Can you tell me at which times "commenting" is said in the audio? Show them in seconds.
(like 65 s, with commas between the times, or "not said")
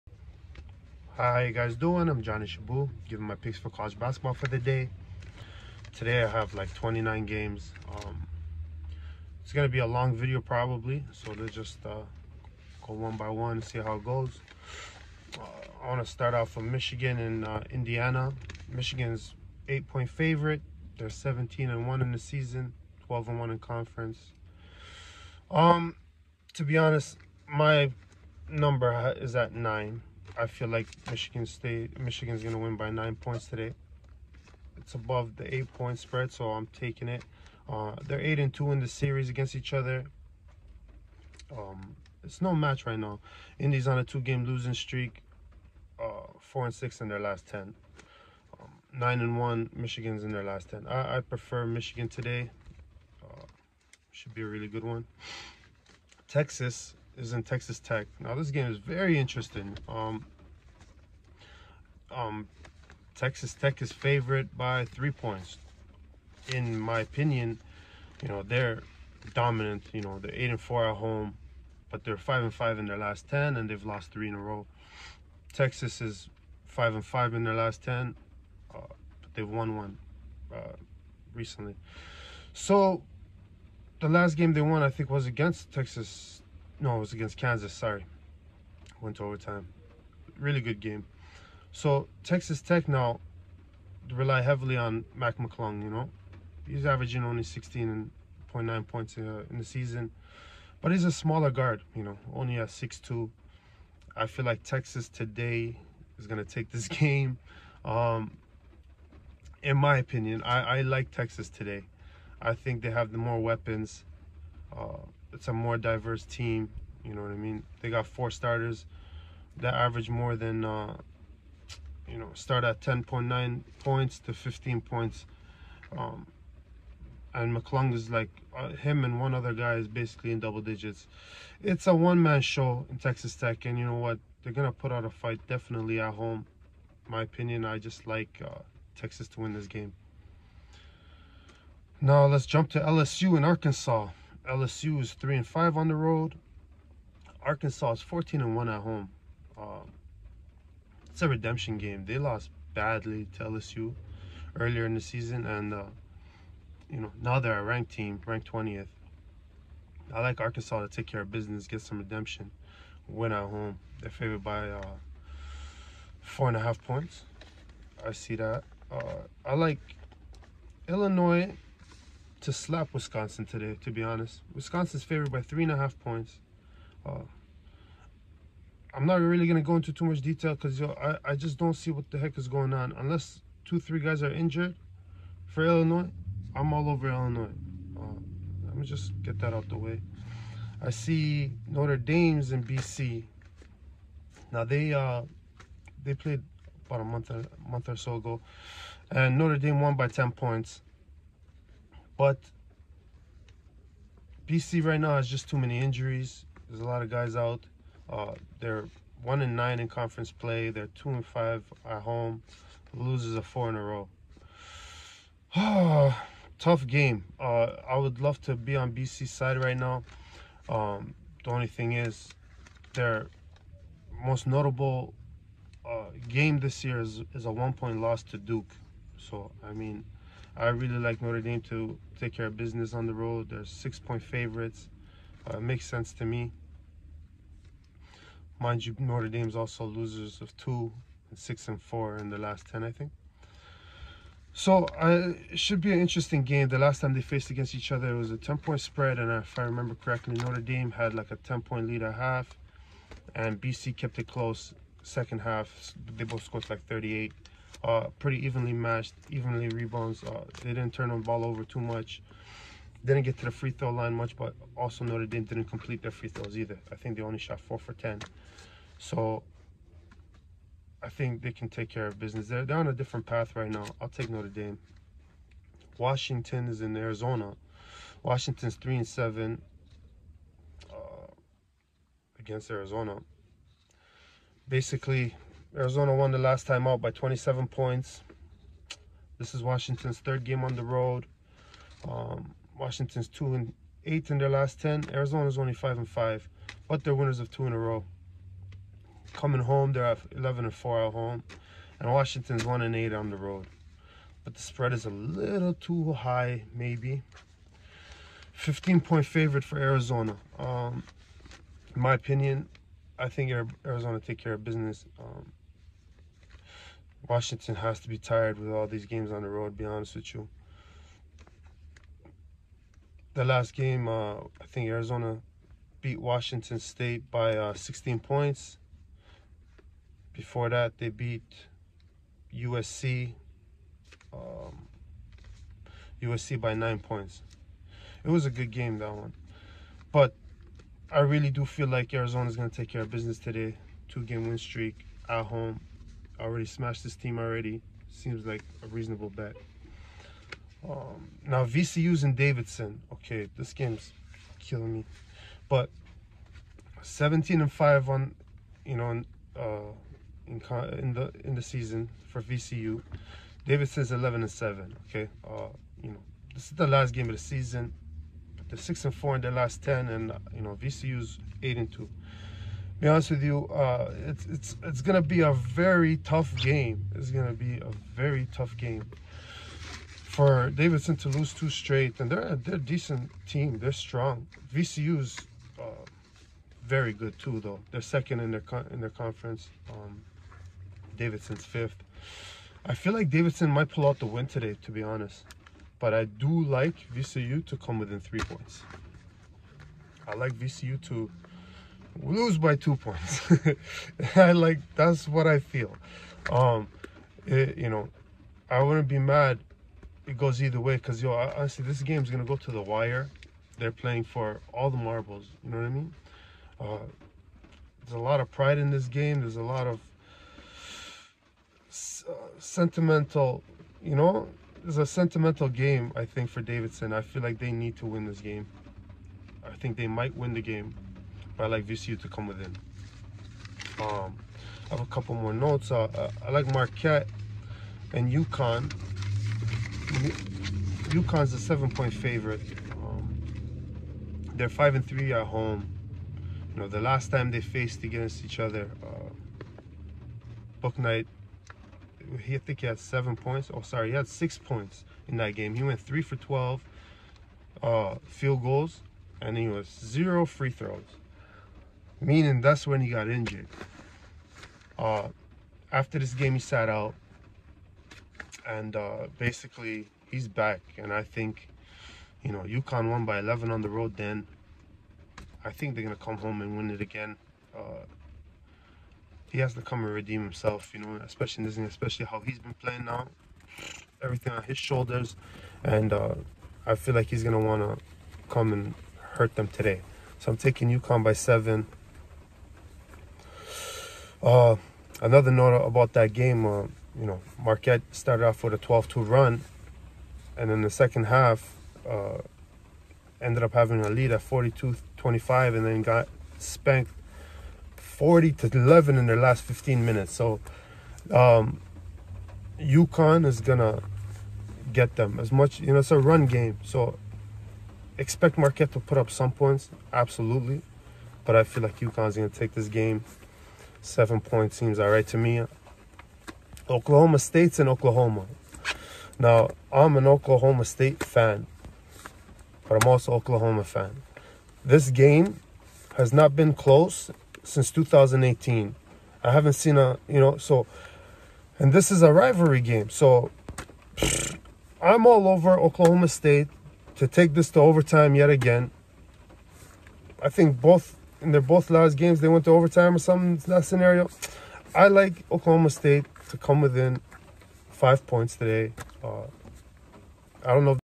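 not said.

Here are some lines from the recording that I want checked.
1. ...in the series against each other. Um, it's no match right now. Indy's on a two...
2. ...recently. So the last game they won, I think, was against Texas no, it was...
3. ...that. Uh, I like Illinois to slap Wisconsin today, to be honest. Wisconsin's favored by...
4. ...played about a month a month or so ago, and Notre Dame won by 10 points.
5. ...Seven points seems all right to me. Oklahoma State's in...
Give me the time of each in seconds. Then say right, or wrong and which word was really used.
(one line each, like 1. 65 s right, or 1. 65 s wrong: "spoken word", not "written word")
1. 38 s right
2. 81 s right
3. 168 s right
4. 196 s right
5. 524 s right.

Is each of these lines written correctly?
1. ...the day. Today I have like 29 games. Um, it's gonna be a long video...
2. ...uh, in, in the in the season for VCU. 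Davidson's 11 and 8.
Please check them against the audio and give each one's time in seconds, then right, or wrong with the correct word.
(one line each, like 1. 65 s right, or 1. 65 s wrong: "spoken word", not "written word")
1. 4 s right
2. 359 s wrong: "7", not "8".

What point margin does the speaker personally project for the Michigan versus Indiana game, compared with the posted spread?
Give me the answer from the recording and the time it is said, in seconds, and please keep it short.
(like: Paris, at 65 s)
9, at 27 s.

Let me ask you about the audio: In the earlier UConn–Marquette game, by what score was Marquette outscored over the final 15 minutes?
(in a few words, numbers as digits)
40 to 11.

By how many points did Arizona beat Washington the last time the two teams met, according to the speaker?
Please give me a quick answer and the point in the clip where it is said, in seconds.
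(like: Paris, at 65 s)
27 points, at 287 s.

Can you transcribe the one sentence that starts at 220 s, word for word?
Um, the only thing is, their most notable uh, game this year is, is a one-point loss to Duke.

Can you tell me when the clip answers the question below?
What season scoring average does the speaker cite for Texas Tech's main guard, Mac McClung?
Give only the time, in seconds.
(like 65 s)
97 s.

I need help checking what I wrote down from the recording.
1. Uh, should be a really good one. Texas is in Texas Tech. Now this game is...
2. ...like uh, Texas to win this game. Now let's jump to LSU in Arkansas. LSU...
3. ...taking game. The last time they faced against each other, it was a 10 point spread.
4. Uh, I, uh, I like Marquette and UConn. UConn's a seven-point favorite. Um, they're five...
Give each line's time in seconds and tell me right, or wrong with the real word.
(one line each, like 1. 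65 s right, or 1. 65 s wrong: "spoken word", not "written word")
1. 53 s right
2. 138 s right
3. 245 s wrong: "interesting", not "taking"
4. 435 s right.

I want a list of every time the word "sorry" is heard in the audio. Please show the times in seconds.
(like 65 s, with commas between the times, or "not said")
87 s, 453 s.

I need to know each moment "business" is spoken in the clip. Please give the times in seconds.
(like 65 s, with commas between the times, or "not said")
161 s, 232 s, 272 s, 314 s, 343 s.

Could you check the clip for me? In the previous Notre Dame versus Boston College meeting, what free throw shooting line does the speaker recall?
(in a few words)
4 for 10.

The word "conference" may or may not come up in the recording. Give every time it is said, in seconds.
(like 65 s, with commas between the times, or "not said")
23 s, 209 s, 389 s.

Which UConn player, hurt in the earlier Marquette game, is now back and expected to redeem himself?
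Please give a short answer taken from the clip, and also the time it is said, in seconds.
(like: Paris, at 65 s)
Bouknight, at 450 s.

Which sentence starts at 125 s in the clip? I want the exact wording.
Um, and McClung is like uh, him and one other guy is basically in double digits.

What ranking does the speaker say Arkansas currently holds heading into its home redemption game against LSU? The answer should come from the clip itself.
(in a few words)
20th.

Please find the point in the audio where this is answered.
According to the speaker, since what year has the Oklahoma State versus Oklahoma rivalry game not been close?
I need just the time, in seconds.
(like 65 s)
537 s.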